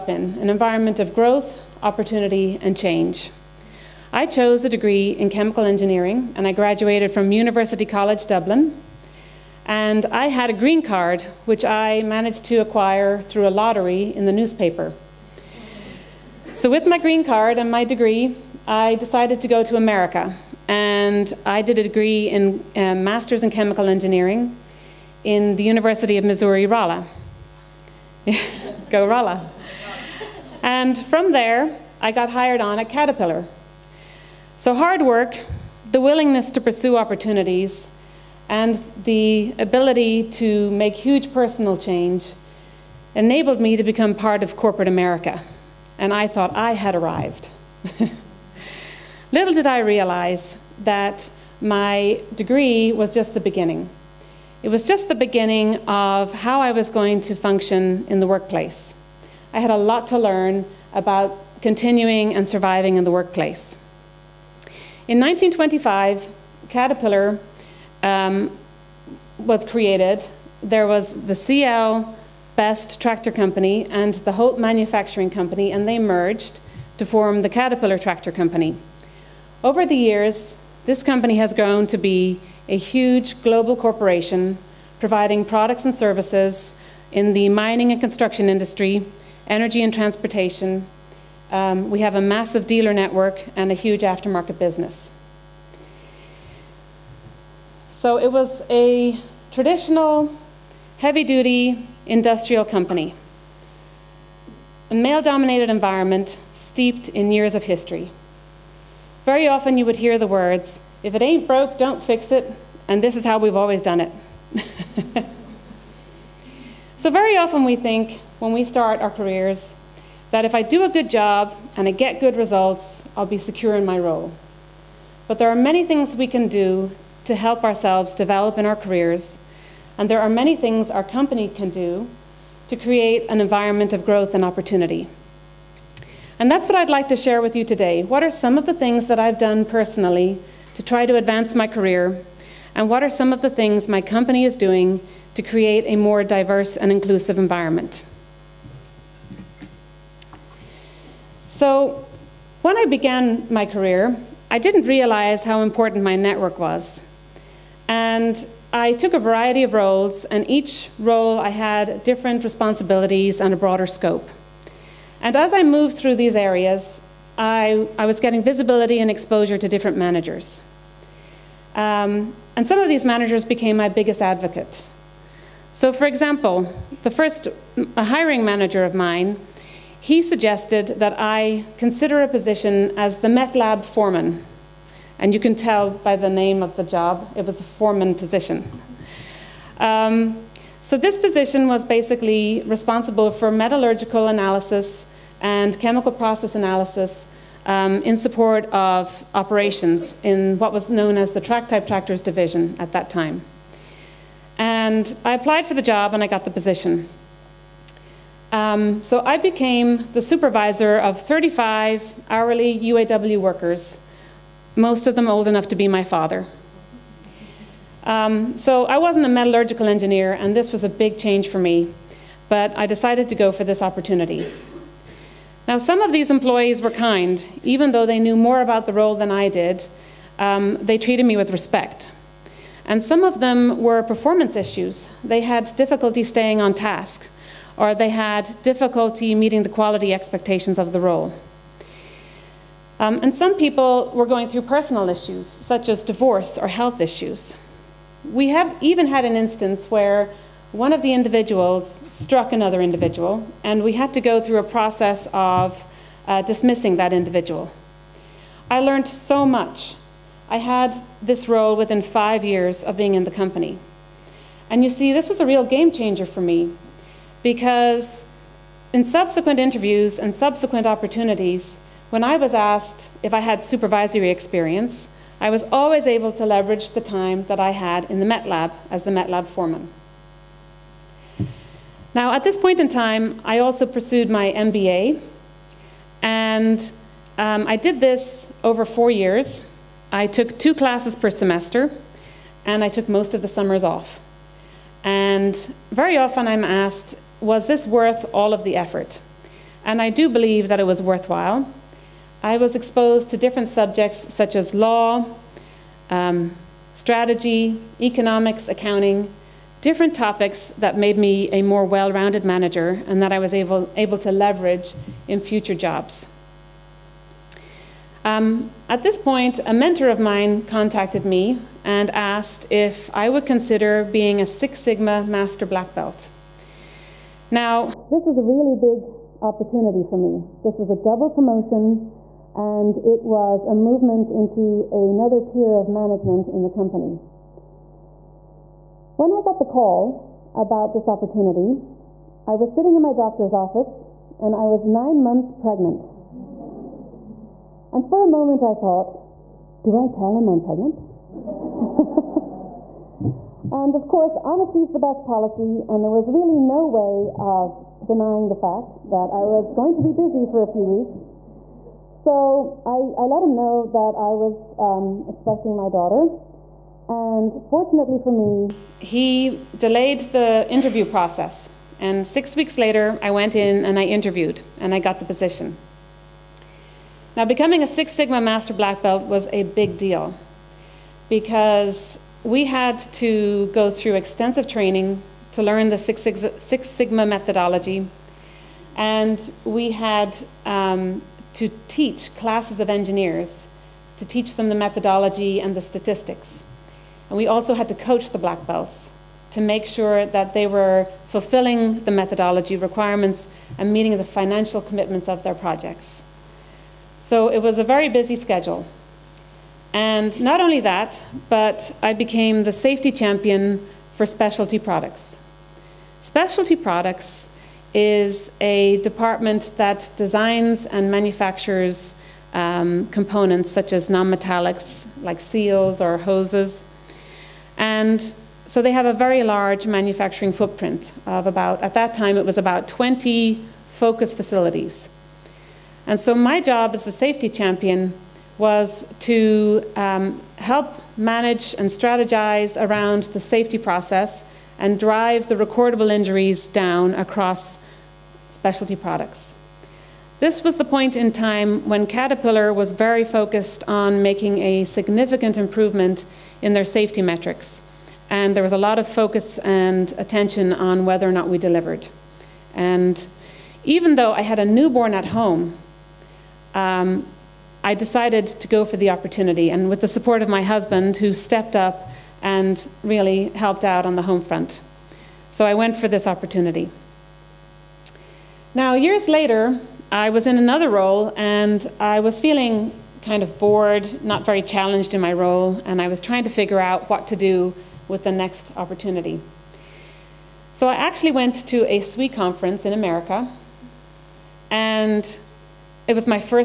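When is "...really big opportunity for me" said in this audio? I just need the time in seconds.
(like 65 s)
328 s.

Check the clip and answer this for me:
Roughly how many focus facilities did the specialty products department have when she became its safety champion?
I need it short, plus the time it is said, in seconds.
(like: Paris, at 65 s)
20, at 432 s.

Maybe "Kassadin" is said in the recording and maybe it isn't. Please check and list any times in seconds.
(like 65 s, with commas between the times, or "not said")
not said.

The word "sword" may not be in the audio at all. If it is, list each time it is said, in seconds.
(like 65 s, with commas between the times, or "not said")
not said.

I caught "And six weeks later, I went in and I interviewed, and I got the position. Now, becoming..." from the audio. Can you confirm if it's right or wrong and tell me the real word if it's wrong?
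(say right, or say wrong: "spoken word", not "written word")
right.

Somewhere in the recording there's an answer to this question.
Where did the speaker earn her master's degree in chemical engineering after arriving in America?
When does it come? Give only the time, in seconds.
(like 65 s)
25 s.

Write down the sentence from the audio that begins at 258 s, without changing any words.
I learned so much I had this role within five years of being in the company.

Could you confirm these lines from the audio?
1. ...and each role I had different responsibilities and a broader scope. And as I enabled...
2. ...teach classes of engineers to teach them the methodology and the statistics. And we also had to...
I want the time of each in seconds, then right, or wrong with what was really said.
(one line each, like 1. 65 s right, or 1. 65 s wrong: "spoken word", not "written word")
1. 160 s wrong: "moved", not "enabled"
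2. 391 s right.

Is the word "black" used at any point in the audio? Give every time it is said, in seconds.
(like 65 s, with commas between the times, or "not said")
325 s, 378 s, 398 s.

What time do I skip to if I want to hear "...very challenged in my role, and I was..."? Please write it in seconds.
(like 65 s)
484 s.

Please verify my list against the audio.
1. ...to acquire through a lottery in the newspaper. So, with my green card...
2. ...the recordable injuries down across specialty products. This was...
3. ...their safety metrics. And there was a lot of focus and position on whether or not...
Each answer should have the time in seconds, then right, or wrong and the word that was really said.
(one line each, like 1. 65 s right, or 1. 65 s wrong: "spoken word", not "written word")
1. 12 s right
2. 445 s right
3. 456 s wrong: "attention", not "position".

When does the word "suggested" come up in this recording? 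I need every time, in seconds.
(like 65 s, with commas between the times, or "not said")
180 s.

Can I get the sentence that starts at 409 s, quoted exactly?
And not only that, but I became the safety champion for specialty products.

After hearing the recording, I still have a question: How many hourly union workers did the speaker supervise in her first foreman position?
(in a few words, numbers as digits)
35.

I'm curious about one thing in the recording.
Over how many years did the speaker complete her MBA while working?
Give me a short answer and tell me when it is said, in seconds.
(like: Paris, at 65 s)
four years, at 288 s.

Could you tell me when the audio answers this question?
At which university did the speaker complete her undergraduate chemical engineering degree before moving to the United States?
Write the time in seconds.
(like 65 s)
7 s.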